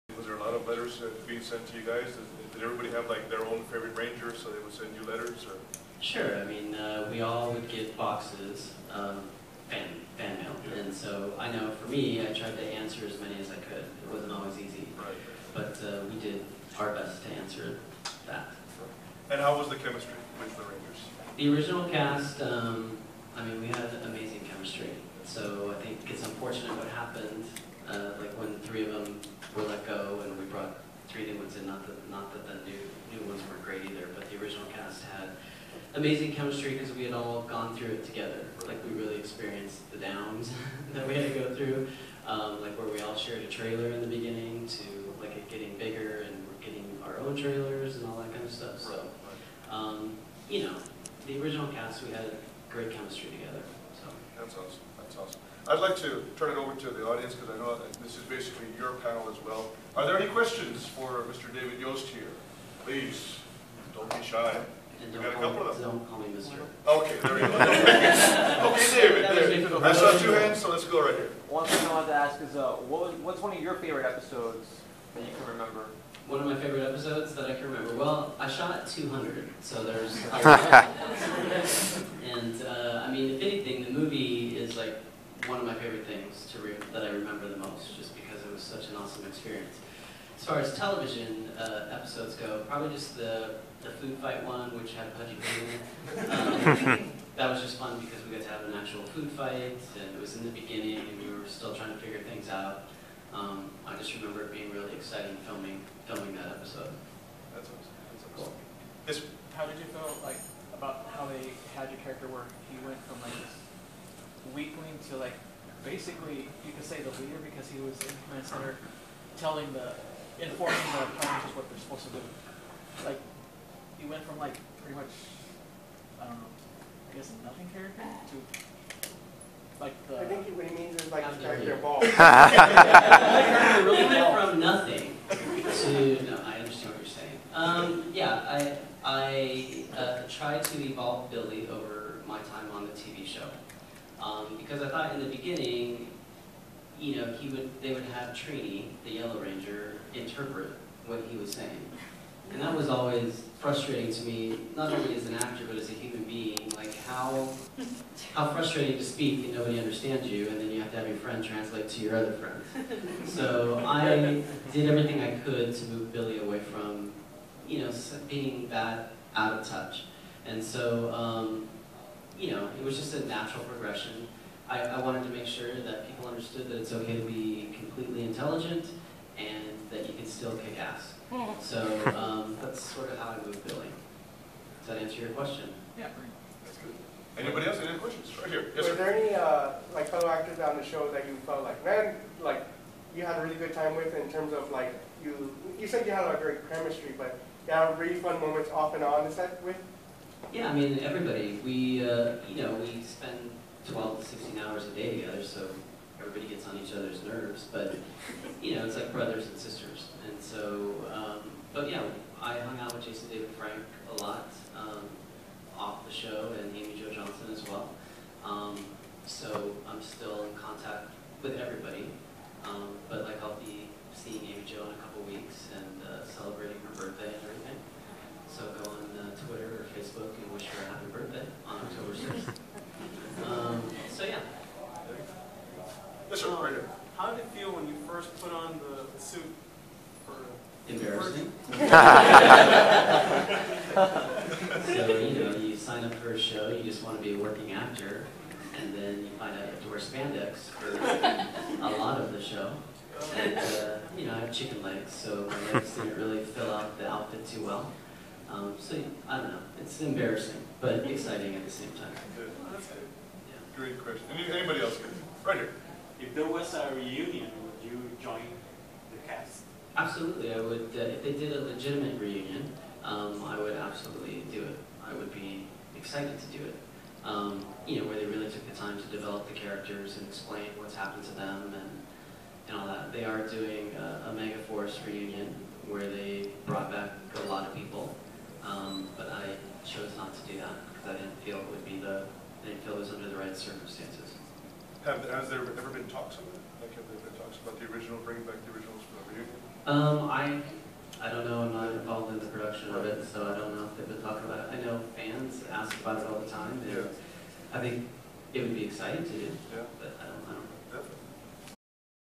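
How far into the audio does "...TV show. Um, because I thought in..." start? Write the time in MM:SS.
02:22.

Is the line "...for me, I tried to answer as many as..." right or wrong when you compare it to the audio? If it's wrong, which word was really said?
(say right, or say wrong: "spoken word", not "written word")
right.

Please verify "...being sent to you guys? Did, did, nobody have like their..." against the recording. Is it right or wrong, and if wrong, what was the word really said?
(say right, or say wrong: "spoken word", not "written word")
wrong: "everybody", not "nobody".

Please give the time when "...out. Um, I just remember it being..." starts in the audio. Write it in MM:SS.
01:42.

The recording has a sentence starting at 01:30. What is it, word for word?
As far as television uh, episodes go, probably just the, the food fight one, which had Pudgy Pig in it.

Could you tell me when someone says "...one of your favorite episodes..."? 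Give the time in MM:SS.
01:13.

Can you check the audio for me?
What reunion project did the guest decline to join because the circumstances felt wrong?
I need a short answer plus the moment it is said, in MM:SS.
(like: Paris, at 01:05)
Mega Force, at 04:44.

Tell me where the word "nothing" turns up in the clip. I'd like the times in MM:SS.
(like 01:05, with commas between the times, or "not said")
02:07, 02:14.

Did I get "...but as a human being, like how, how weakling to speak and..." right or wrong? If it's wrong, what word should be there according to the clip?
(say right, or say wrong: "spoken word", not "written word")
wrong: "frustrating", not "weakling".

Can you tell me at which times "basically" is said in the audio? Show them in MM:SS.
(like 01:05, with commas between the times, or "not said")
00:58, 01:55.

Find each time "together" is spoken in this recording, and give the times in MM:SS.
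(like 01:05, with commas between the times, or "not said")
00:38, 00:53, 03:25.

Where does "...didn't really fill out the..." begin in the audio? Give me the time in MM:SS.
04:15.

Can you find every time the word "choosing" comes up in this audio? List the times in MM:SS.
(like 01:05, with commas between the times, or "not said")
not said.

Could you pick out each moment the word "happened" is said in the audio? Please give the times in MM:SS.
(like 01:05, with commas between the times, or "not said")
00:26, 04:40.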